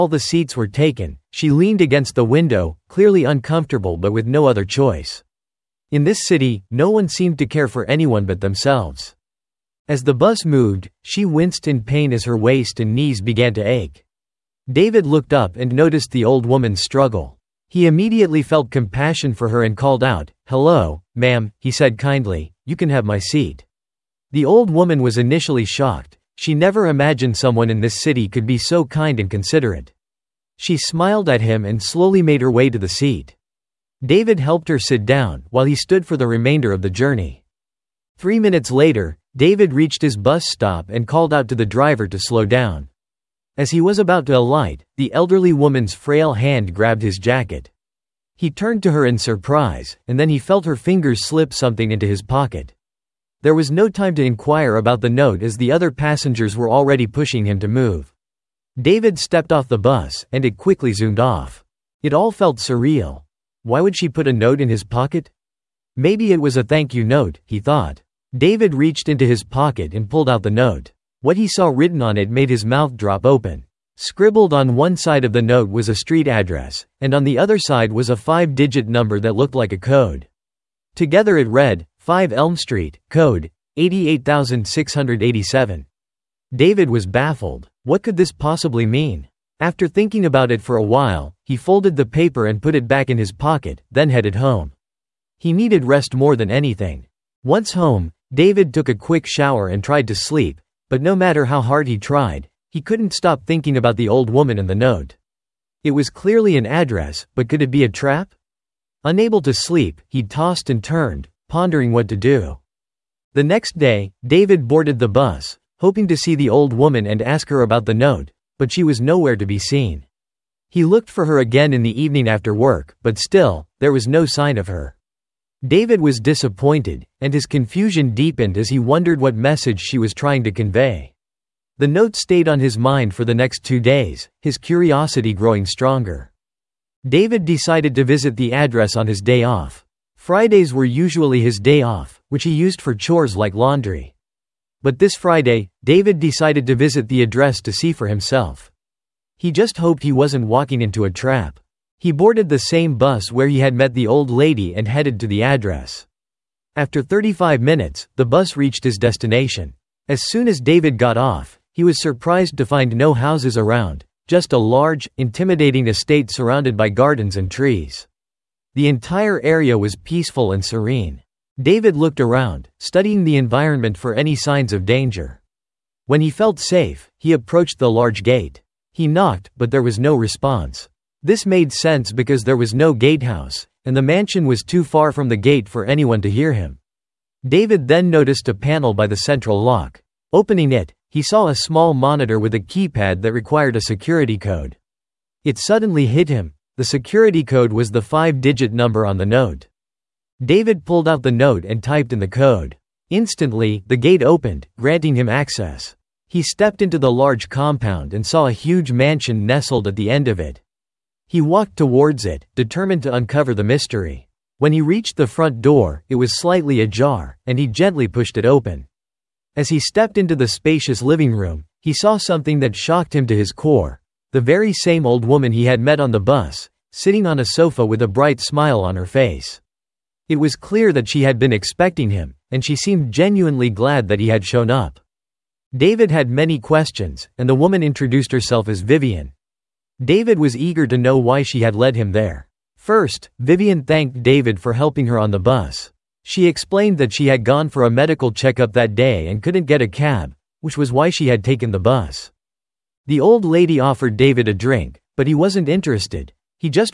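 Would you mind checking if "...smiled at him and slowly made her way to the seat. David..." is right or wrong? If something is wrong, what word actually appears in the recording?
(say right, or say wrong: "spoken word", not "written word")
right.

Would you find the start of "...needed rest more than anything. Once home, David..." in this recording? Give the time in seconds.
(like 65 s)
95 s.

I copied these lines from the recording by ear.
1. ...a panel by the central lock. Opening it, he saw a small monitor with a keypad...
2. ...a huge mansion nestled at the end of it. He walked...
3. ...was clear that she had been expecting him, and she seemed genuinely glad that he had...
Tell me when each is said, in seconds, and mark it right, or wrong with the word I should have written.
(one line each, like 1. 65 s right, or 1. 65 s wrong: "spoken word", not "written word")
1. 188 s right
2. 208 s right
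3. 230 s right.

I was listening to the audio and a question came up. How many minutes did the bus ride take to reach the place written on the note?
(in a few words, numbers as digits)
35.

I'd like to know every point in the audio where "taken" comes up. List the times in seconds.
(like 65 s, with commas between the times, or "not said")
0 s, 251 s.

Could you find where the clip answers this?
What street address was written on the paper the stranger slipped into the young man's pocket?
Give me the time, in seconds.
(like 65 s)
81 s.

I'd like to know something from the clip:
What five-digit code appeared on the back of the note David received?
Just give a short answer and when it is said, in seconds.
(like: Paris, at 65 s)
88687, at 83 s.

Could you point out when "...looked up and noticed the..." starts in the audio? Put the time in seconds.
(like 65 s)
15 s.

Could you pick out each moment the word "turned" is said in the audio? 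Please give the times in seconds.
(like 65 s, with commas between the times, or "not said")
48 s, 110 s.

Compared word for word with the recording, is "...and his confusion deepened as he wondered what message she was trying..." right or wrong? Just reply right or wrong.
right.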